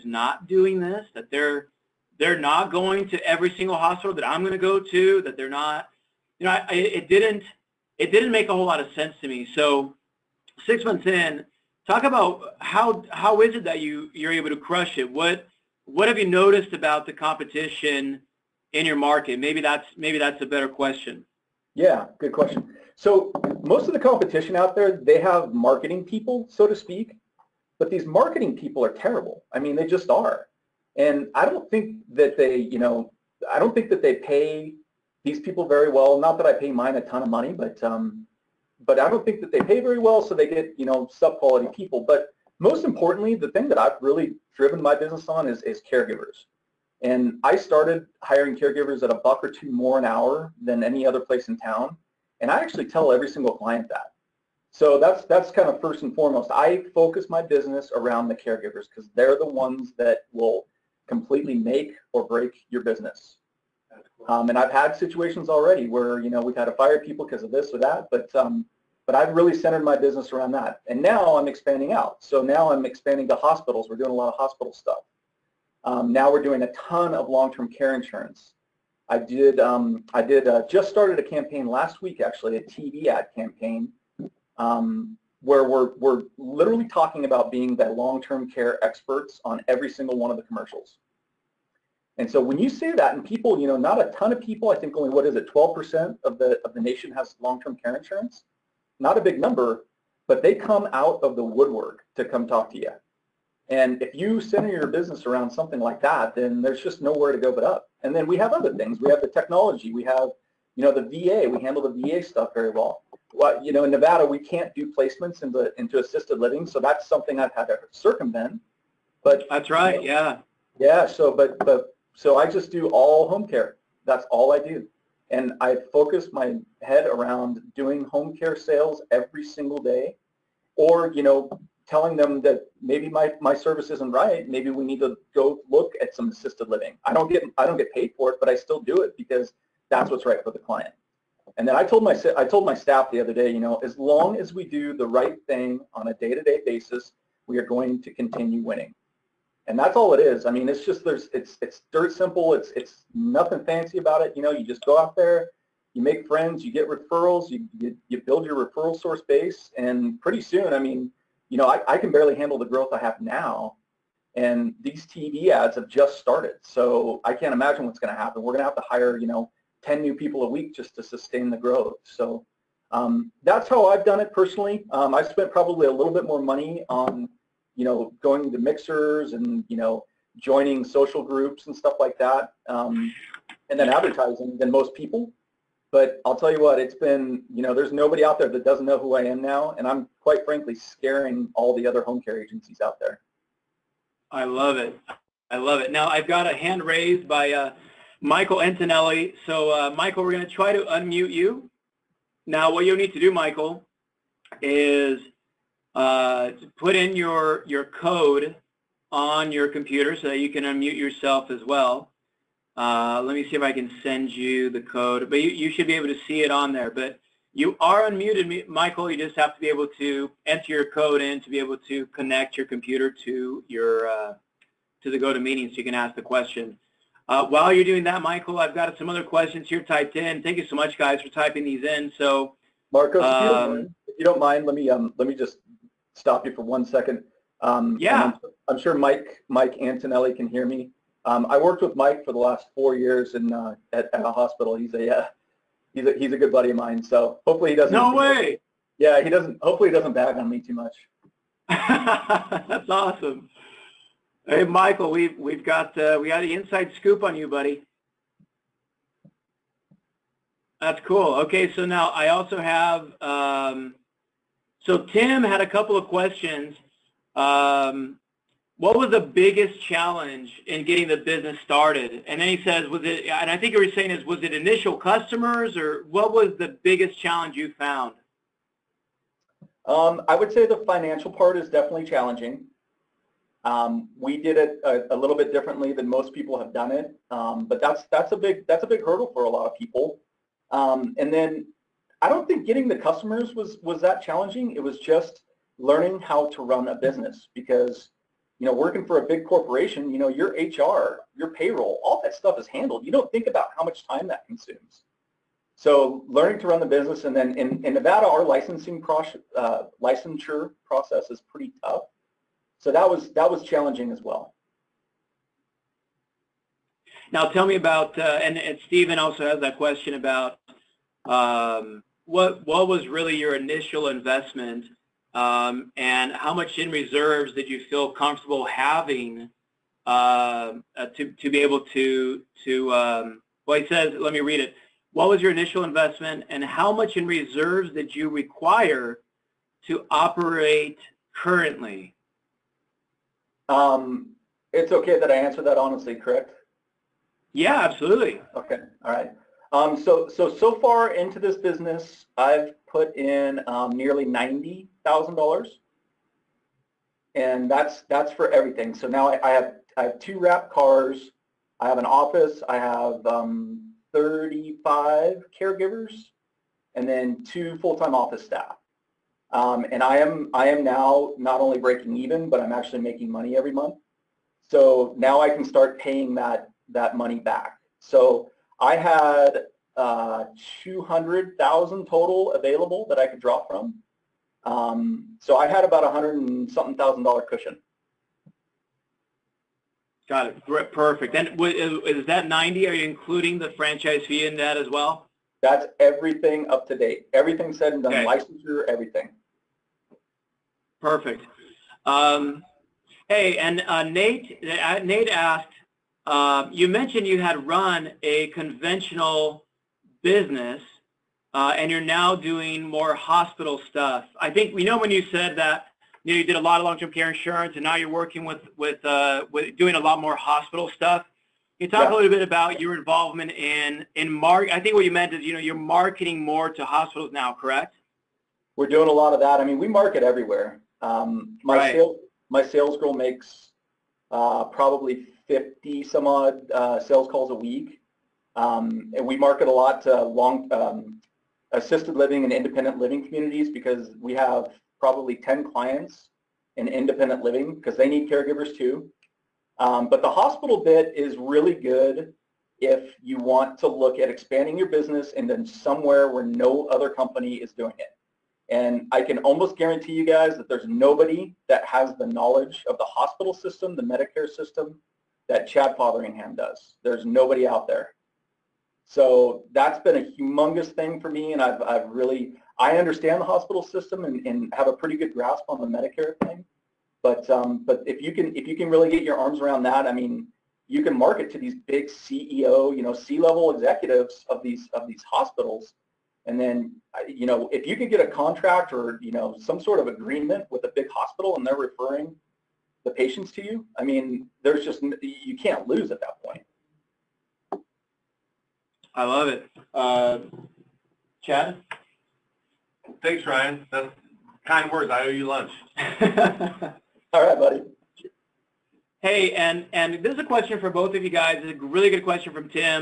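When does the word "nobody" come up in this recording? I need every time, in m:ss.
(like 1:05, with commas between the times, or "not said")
3:07, 7:40, 7:47.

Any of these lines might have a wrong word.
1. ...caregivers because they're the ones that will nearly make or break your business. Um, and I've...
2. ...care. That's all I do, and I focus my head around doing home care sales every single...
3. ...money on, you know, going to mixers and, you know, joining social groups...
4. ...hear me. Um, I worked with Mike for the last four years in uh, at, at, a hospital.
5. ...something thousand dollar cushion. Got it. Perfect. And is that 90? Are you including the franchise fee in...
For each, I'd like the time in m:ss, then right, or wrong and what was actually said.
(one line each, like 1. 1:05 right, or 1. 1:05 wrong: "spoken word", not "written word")
1. 0:58 wrong: "completely", not "nearly"
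2. 2:03 right
3. 2:56 right
4. 4:00 right
5. 6:26 right.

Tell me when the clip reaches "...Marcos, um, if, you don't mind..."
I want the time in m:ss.
3:52.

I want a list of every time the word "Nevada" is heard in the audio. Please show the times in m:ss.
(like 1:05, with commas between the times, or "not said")
1:53, 5:07.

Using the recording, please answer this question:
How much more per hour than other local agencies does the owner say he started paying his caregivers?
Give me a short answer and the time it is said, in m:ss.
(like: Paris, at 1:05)
a buck or two, at 0:49.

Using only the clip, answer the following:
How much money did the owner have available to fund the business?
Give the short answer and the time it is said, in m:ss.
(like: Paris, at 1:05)
$200,000, at 6:20.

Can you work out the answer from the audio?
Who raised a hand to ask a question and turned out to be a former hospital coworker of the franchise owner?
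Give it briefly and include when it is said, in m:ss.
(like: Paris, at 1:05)
Michael Antonelli, at 3:18.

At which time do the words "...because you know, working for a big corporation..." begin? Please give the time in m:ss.
4:57.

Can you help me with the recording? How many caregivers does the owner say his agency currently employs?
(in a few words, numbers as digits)
35.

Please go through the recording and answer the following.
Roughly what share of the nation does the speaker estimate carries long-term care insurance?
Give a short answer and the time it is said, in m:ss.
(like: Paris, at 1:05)
12%, at 1:35.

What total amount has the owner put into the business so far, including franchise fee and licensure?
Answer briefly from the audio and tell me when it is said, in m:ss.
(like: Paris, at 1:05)
nearly $90,000, at 5:53.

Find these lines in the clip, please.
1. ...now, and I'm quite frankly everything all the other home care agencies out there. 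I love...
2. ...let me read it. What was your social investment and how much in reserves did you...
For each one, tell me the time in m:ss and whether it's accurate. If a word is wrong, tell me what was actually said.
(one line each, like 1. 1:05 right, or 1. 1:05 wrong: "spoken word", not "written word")
1. 3:09 wrong: "scaring", not "everything"
2. 5:34 wrong: "initial", not "social".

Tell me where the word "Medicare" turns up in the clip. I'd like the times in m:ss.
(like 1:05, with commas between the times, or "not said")
7:44, 7:55.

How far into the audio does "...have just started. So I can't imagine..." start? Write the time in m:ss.
2:45.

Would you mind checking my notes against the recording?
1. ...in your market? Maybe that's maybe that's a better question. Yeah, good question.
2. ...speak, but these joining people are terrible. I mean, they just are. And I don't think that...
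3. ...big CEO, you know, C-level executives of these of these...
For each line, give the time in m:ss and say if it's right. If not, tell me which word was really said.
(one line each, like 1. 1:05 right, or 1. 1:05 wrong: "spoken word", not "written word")
1. 0:18 right
2. 0:26 wrong: "marketing", not "joining"
3. 8:01 right.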